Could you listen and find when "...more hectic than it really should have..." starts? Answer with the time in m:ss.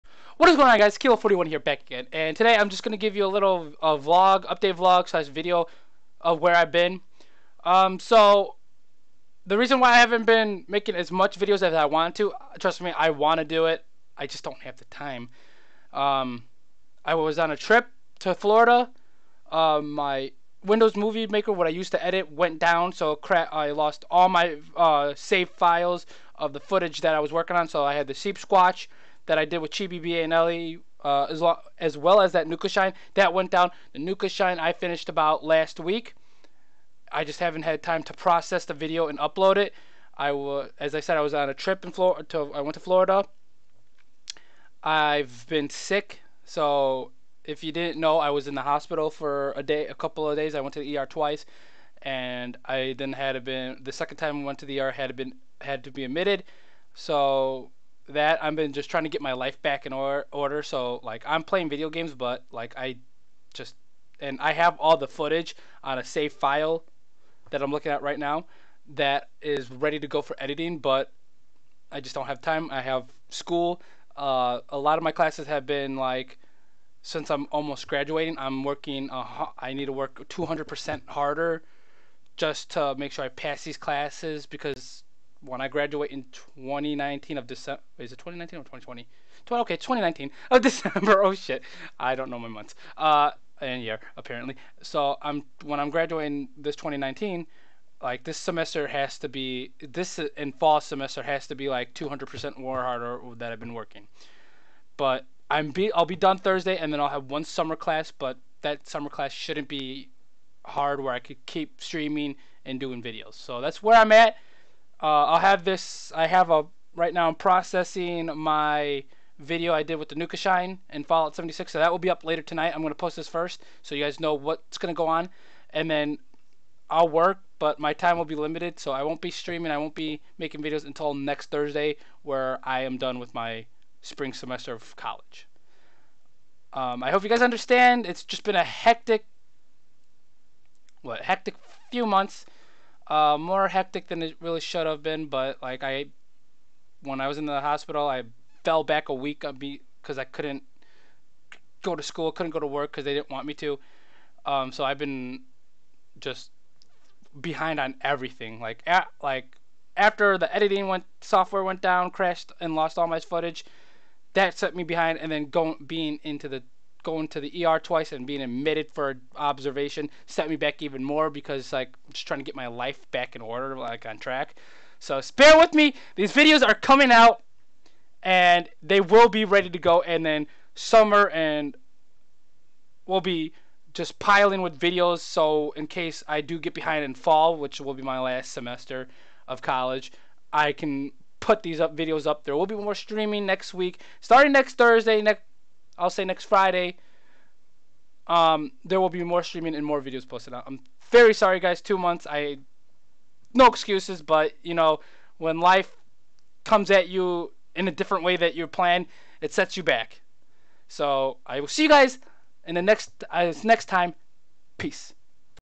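2:23.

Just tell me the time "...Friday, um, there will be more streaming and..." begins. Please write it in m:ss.
3:16.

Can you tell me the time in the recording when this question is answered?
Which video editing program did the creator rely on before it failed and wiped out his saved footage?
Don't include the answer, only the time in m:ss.
0:20.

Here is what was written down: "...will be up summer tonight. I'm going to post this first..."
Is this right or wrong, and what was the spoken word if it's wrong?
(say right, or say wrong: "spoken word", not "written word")
wrong: "later", not "summer".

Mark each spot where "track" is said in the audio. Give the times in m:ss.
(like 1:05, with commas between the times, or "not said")
2:54.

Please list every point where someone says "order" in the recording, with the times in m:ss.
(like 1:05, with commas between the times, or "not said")
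1:00, 2:53.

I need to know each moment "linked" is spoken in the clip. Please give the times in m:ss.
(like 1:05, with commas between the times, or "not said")
not said.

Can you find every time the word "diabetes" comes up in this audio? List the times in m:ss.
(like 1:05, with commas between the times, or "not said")
not said.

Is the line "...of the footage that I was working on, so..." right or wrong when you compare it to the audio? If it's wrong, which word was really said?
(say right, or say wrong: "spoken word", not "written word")
right.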